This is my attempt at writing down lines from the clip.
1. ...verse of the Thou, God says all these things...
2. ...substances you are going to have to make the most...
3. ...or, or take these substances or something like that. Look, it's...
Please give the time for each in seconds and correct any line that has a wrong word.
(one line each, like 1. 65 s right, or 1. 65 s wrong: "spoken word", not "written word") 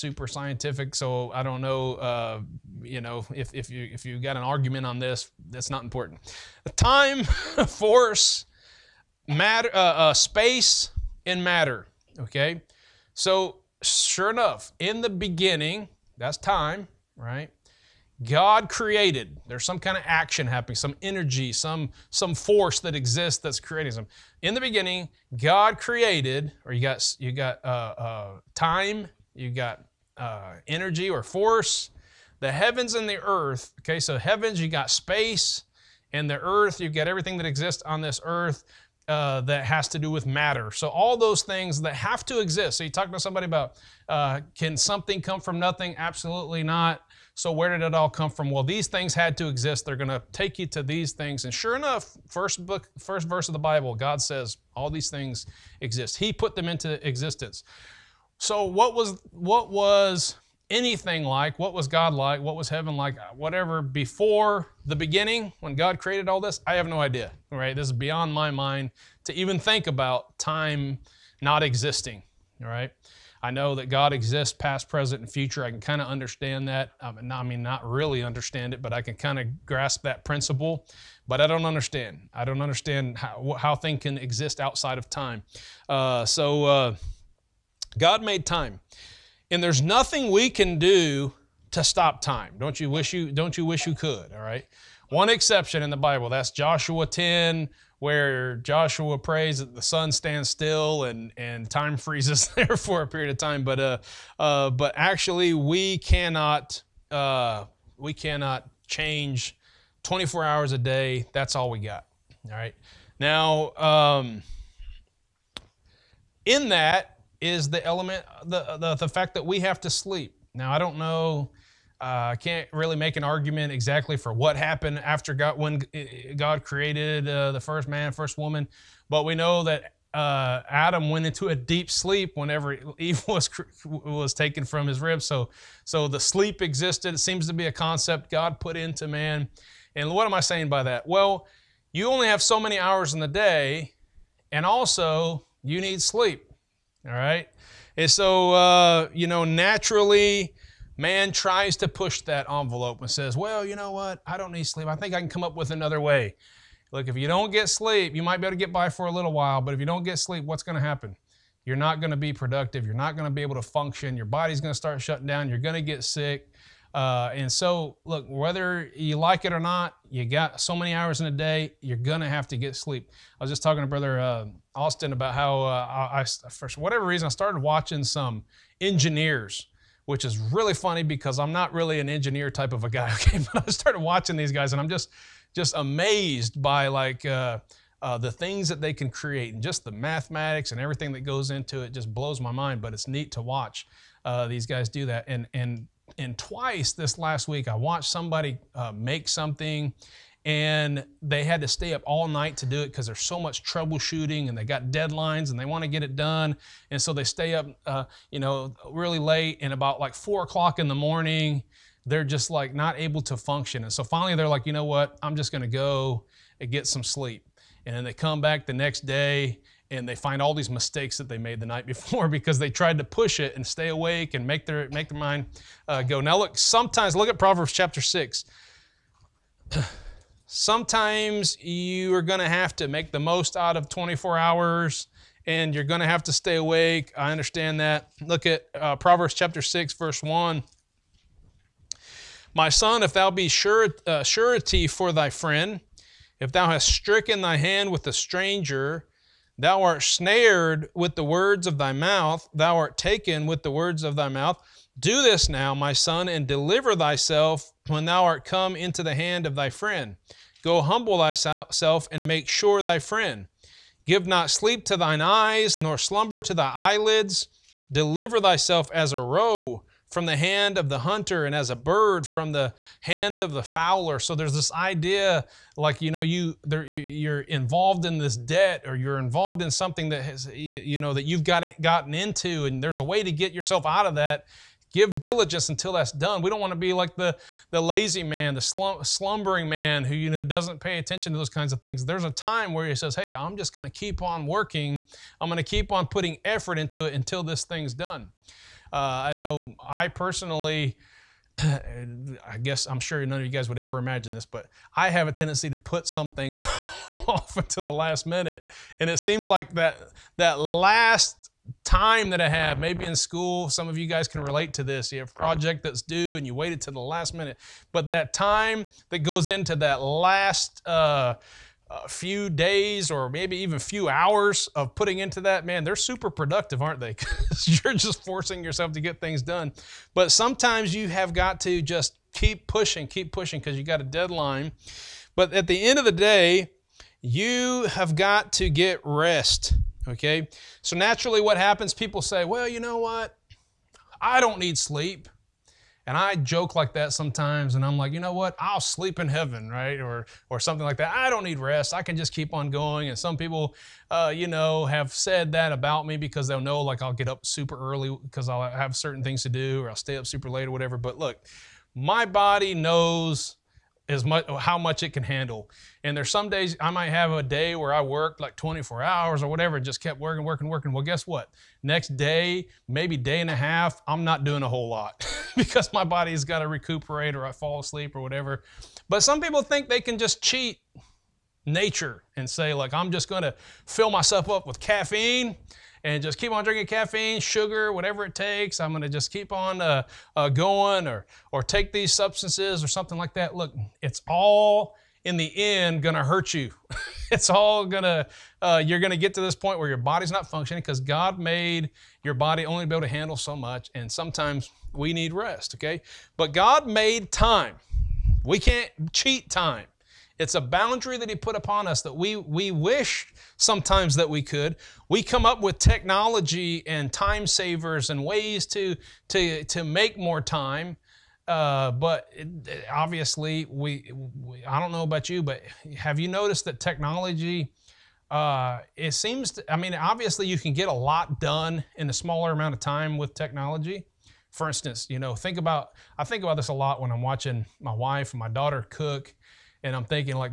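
1. 53 s wrong: "Bible", not "Thou"
2. 230 s wrong: "sometimes", not "substances"
3. 391 s right.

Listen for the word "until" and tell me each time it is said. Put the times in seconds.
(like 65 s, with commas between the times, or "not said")
285 s, 297 s, 307 s.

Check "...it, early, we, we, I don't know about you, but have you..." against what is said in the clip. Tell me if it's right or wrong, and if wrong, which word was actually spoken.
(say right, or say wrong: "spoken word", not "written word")
wrong: "obviously", not "early".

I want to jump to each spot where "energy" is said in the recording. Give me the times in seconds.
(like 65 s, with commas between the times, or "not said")
21 s, 30 s.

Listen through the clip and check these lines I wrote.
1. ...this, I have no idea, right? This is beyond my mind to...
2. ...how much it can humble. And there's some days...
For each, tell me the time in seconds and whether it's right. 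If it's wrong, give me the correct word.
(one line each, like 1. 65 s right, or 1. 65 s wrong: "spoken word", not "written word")
1. 66 s right
2. 364 s wrong: "handle", not "humble".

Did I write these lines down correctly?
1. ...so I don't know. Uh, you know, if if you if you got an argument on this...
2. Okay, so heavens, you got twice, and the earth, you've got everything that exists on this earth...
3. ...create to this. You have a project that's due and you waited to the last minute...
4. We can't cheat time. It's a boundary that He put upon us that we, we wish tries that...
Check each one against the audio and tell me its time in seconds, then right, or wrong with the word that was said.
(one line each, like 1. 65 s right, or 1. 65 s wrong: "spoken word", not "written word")
1. 0 s right
2. 33 s wrong: "space", not "twice"
3. 314 s wrong: "relate", not "create"
4. 408 s wrong: "sometimes", not "tries".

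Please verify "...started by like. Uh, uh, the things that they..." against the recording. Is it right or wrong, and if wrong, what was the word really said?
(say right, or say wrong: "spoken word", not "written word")
wrong: "amazed", not "started".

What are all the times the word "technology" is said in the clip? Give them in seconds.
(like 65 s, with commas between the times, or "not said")
415 s, 426 s, 433 s.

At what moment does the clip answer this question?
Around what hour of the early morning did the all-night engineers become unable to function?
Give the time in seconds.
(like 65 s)
210 s.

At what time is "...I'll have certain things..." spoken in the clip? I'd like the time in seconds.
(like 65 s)
358 s.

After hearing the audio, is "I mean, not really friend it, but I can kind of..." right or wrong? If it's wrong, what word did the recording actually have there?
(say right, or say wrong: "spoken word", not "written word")
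wrong: "understand", not "friend".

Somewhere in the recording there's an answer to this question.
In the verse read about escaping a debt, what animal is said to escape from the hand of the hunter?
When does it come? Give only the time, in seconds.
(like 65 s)
269 s.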